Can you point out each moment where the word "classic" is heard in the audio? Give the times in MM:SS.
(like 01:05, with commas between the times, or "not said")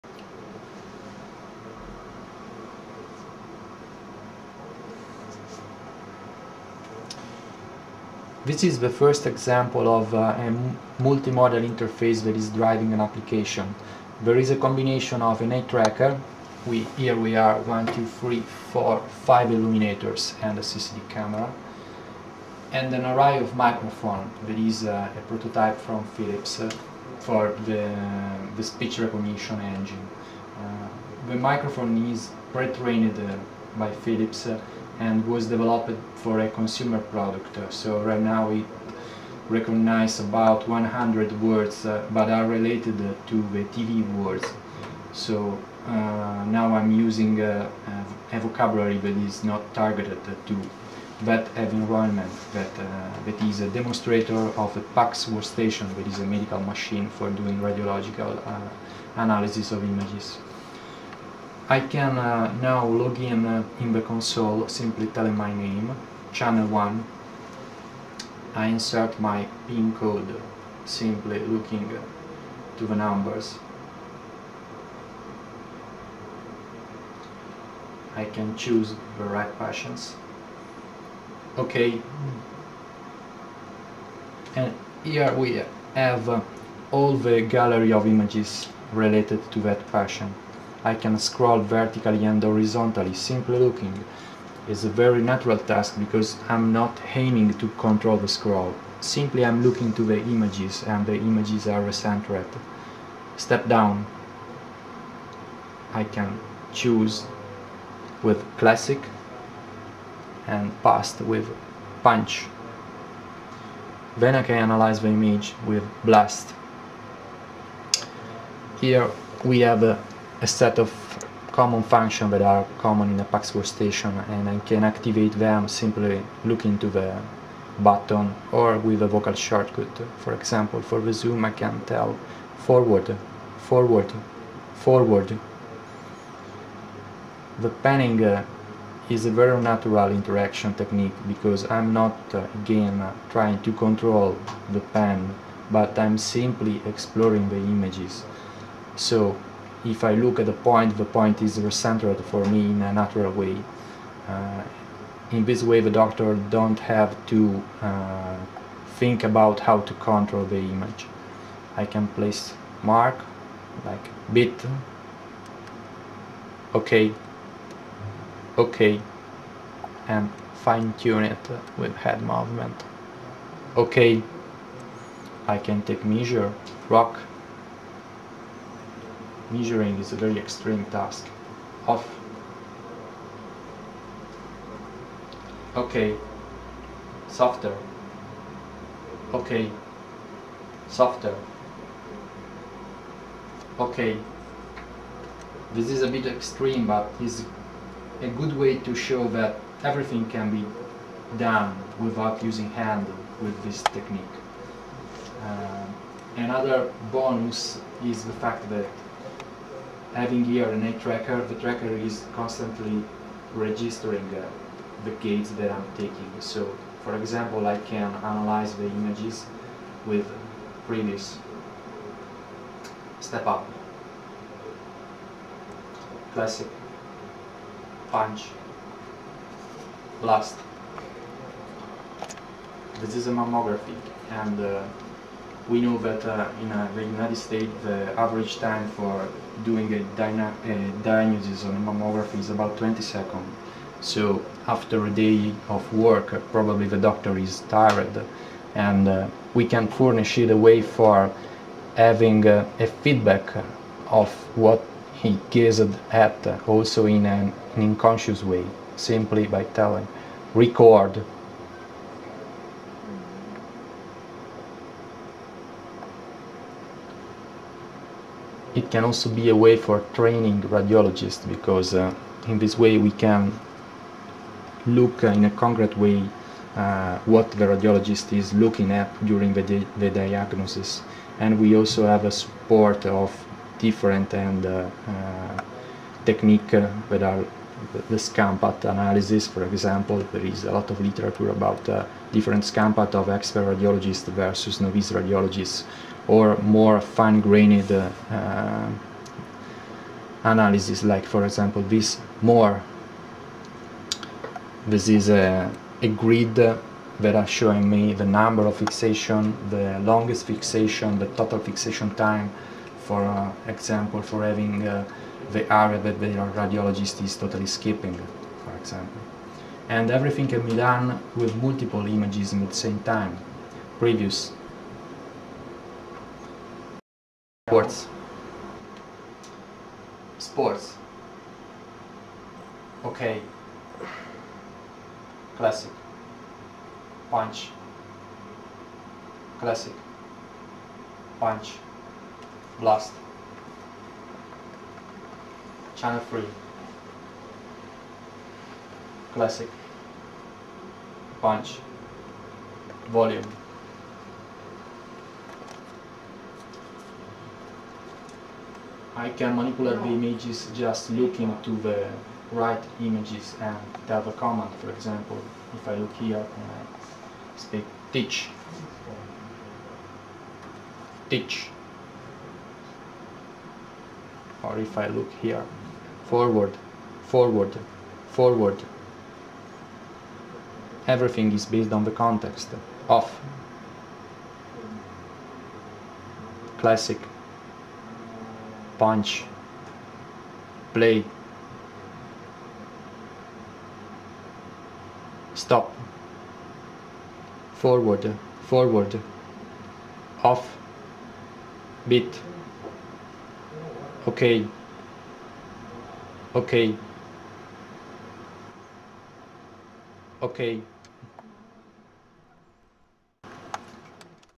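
01:48, 03:46, 05:35, 05:39, 05:49, 06:26.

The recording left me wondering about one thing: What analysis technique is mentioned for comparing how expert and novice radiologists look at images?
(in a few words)
scanpath analysis.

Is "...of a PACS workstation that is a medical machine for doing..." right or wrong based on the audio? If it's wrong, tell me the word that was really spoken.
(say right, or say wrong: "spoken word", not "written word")
right.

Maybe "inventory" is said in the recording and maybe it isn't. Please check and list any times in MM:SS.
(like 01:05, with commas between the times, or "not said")
not said.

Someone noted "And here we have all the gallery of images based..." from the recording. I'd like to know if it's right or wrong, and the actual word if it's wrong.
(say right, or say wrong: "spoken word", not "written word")
wrong: "related", not "based".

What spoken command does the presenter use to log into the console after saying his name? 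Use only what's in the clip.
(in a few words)
channel 1.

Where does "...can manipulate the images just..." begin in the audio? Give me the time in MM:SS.
05:59.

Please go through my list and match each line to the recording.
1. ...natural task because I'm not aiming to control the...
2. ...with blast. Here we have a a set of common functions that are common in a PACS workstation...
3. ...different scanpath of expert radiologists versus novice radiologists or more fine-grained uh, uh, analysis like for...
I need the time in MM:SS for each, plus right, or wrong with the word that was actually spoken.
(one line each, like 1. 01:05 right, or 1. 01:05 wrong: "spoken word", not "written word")
1. 01:35 right
2. 01:55 right
3. 04:52 right.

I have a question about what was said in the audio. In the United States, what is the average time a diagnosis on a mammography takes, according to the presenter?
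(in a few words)
20 seconds.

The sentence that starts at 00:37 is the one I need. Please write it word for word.
So right now it recognize about 100 words uh, but are related to the TV words.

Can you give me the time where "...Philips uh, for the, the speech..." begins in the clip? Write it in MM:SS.
00:26.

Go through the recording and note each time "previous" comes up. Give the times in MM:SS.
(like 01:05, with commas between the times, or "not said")
03:40, 05:23.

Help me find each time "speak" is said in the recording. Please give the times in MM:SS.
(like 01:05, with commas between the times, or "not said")
06:07.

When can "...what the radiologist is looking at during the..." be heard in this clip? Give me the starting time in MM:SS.
04:37.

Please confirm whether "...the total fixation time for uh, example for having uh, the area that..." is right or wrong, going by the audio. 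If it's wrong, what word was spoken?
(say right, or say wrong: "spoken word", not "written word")
right.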